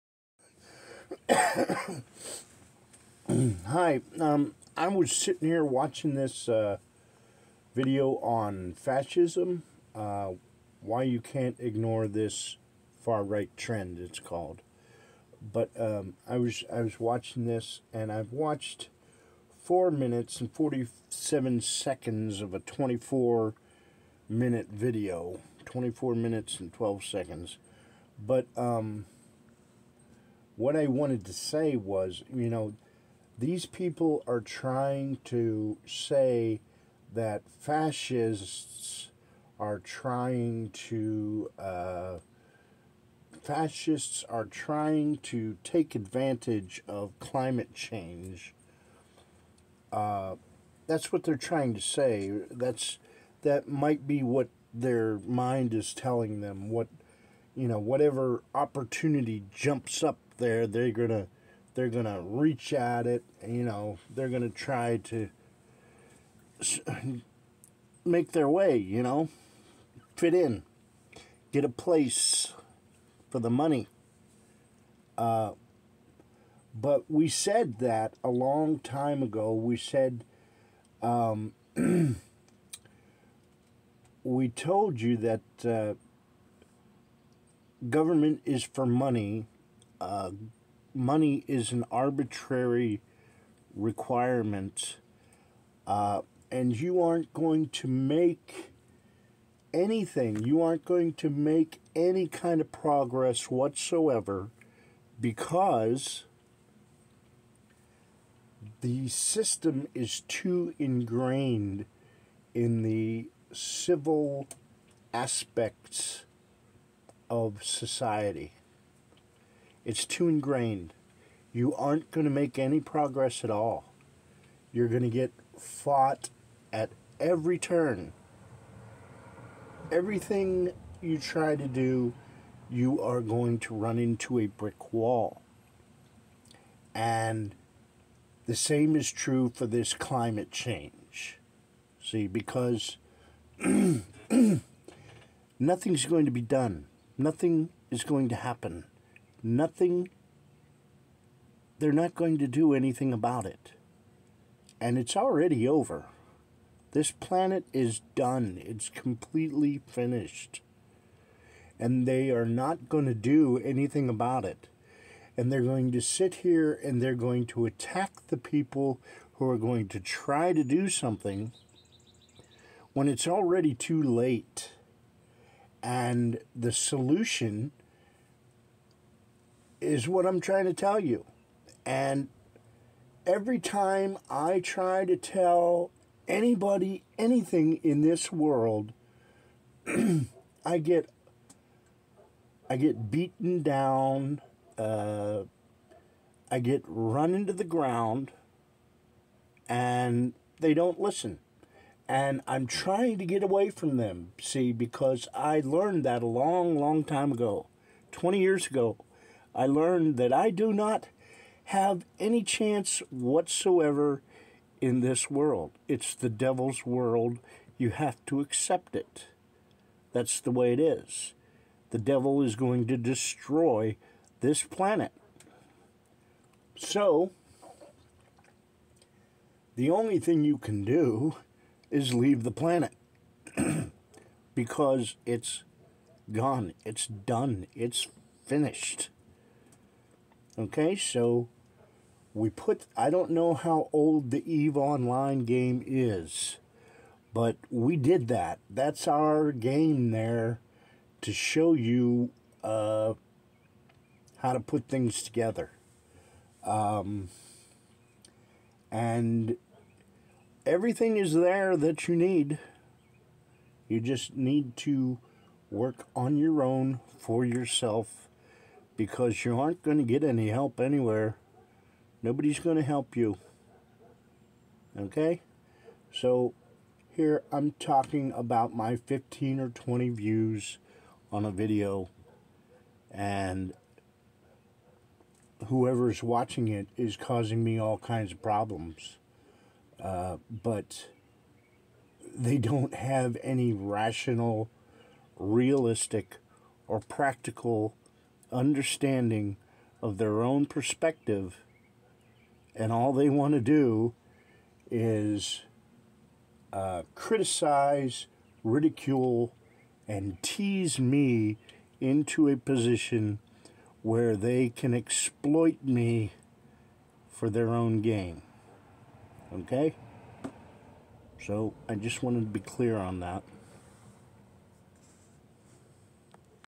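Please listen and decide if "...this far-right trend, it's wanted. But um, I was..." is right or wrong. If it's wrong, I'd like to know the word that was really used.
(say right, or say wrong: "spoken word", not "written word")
wrong: "called", not "wanted".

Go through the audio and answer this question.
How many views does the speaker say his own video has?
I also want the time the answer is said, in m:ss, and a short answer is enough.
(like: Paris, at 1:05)
15 or 20, at 4:38.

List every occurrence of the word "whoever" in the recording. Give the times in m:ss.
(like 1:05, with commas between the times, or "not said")
4:45.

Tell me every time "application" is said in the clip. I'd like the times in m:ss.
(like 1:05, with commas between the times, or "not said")
not said.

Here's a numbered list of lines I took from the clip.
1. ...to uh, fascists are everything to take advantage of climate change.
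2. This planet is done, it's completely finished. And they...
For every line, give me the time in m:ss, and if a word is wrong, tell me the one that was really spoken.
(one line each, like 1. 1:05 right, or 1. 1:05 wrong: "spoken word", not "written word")
1. 0:40 wrong: "trying", not "everything"
2. 2:36 right.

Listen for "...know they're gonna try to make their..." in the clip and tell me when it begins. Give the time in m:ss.
1:03.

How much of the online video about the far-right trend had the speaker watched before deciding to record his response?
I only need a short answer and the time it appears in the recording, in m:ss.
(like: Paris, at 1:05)
4 minutes and 47 seconds, at 0:19.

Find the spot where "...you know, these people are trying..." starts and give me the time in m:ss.
0:32.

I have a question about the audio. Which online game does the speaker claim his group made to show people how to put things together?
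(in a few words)
EVE Online.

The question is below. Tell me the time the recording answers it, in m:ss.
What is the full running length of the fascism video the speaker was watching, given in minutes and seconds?
0:25.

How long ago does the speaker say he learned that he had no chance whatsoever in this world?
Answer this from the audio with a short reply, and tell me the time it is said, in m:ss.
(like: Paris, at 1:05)
20 years ago, at 3:28.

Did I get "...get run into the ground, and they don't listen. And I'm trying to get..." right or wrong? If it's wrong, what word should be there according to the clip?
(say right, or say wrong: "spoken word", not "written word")
right.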